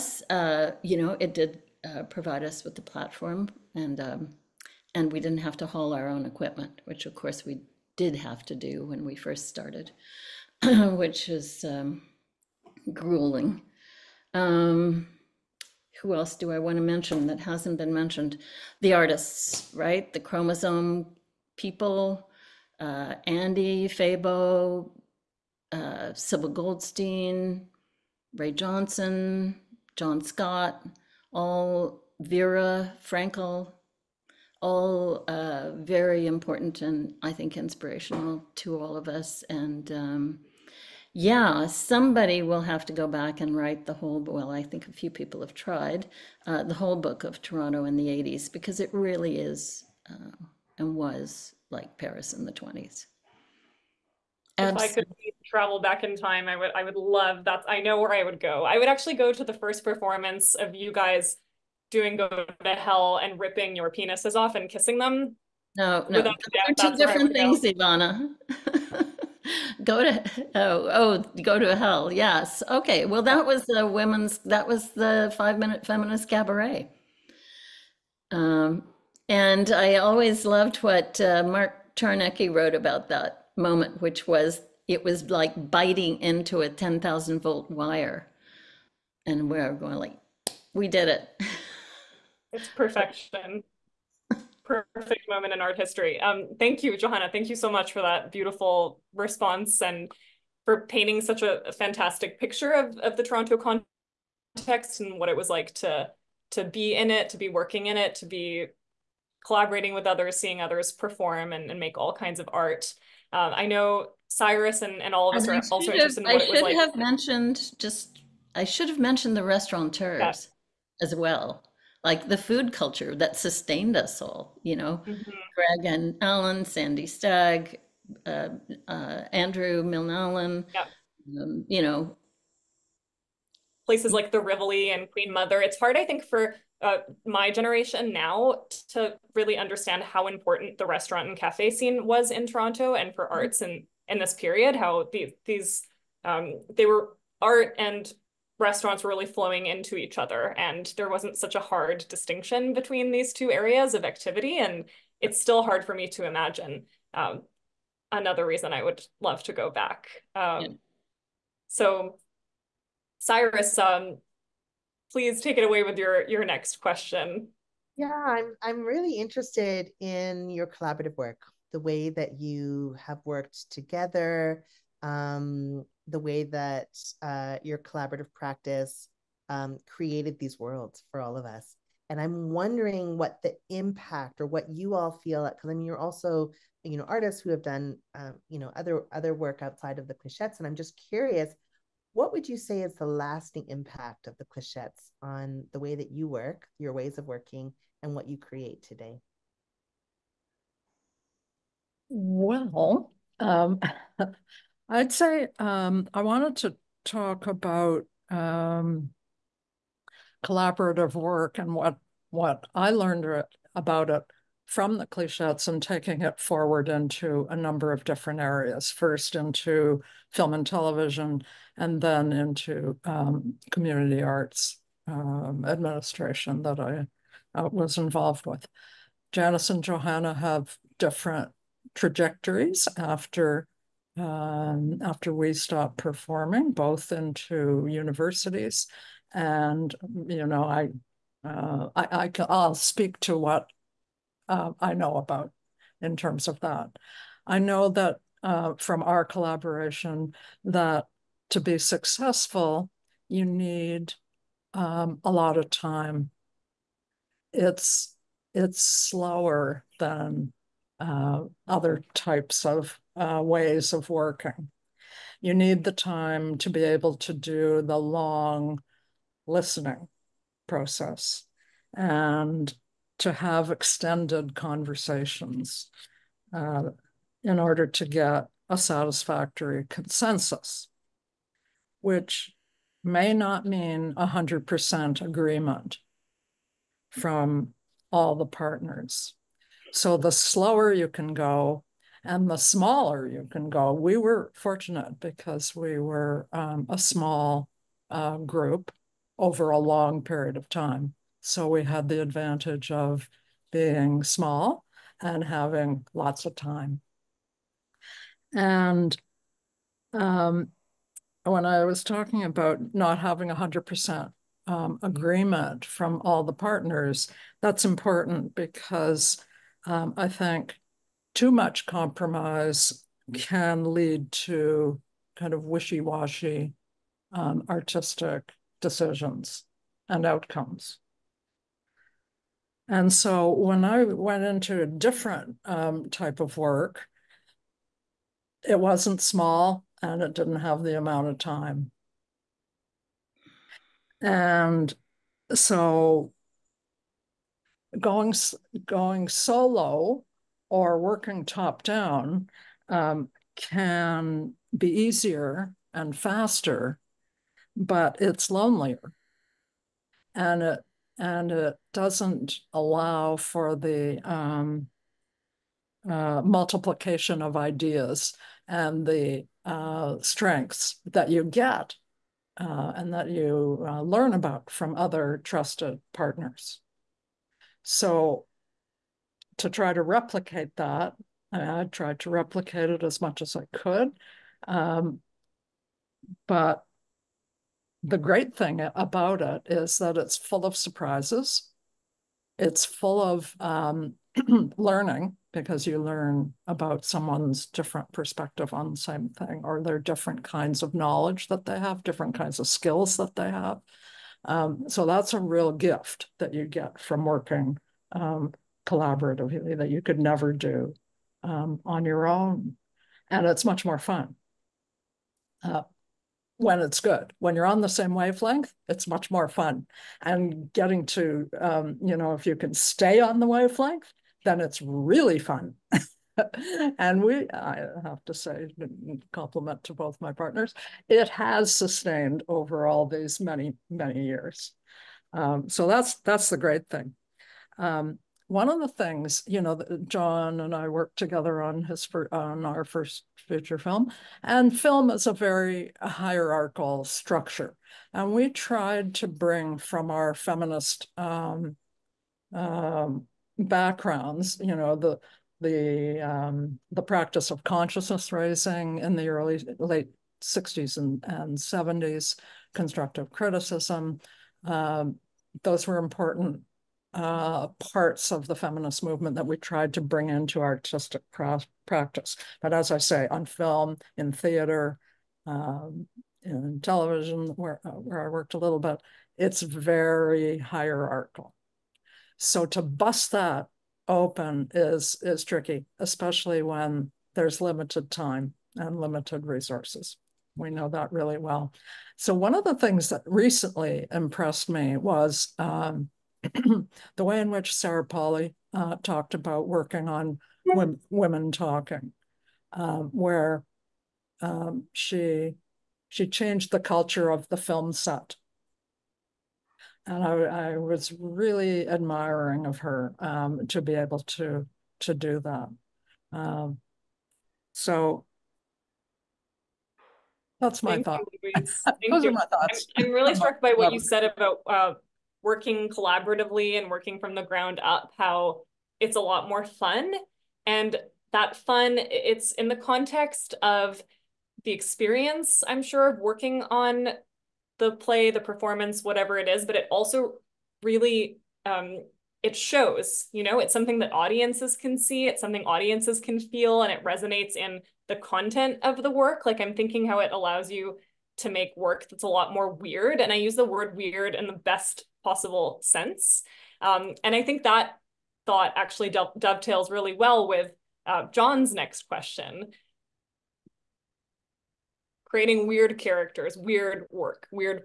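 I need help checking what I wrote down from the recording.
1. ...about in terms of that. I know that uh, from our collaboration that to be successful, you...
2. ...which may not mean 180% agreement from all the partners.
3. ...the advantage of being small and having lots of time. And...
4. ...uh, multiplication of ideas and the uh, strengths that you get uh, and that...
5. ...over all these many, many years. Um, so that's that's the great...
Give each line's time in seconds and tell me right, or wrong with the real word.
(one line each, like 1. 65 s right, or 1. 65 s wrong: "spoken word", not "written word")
1. 245 s right
2. 282 s wrong: "100", not "180"
3. 302 s right
4. 366 s right
5. 432 s right.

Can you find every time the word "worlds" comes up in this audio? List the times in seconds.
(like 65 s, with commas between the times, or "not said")
180 s.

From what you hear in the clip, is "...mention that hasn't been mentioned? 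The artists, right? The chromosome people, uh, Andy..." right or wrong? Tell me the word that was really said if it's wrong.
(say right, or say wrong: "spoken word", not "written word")
right.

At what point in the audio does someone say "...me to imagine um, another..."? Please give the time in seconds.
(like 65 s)
155 s.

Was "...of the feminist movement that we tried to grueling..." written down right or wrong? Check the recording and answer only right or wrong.
wrong.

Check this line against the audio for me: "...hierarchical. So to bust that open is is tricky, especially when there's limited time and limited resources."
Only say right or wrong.
right.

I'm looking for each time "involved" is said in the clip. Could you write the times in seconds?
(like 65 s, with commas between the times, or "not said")
227 s.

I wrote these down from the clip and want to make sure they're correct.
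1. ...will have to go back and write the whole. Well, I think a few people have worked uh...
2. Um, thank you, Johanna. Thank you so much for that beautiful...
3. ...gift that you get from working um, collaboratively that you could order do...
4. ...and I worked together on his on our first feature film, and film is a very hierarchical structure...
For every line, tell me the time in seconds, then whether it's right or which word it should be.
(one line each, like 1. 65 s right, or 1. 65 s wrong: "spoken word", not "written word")
1. 42 s wrong: "tried", not "worked"
2. 96 s right
3. 405 s wrong: "never", not "order"
4. 440 s right.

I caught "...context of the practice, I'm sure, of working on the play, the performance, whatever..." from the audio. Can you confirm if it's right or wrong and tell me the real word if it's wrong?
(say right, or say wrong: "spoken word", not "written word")
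wrong: "experience", not "practice".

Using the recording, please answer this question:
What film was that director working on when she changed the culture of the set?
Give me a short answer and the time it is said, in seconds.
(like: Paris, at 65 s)
Women Talking, at 501 s.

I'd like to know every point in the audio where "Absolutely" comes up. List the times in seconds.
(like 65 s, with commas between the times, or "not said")
54 s.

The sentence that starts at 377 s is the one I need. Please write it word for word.
So to try to replicate that.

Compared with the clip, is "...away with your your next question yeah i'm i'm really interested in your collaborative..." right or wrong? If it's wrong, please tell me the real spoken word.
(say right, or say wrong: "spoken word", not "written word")
right.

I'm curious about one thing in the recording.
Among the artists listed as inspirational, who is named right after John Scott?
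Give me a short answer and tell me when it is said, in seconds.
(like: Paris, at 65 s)
Vera Frankel, at 32 s.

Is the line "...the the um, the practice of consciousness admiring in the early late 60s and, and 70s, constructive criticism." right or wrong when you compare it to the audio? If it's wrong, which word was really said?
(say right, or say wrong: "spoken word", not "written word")
wrong: "raising", not "admiring".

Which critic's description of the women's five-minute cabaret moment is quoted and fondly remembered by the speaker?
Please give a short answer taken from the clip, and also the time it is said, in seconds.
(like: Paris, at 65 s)
Mark Czarnecki, at 81 s.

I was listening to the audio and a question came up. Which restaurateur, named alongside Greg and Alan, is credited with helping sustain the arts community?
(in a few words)
Sandy Stagg.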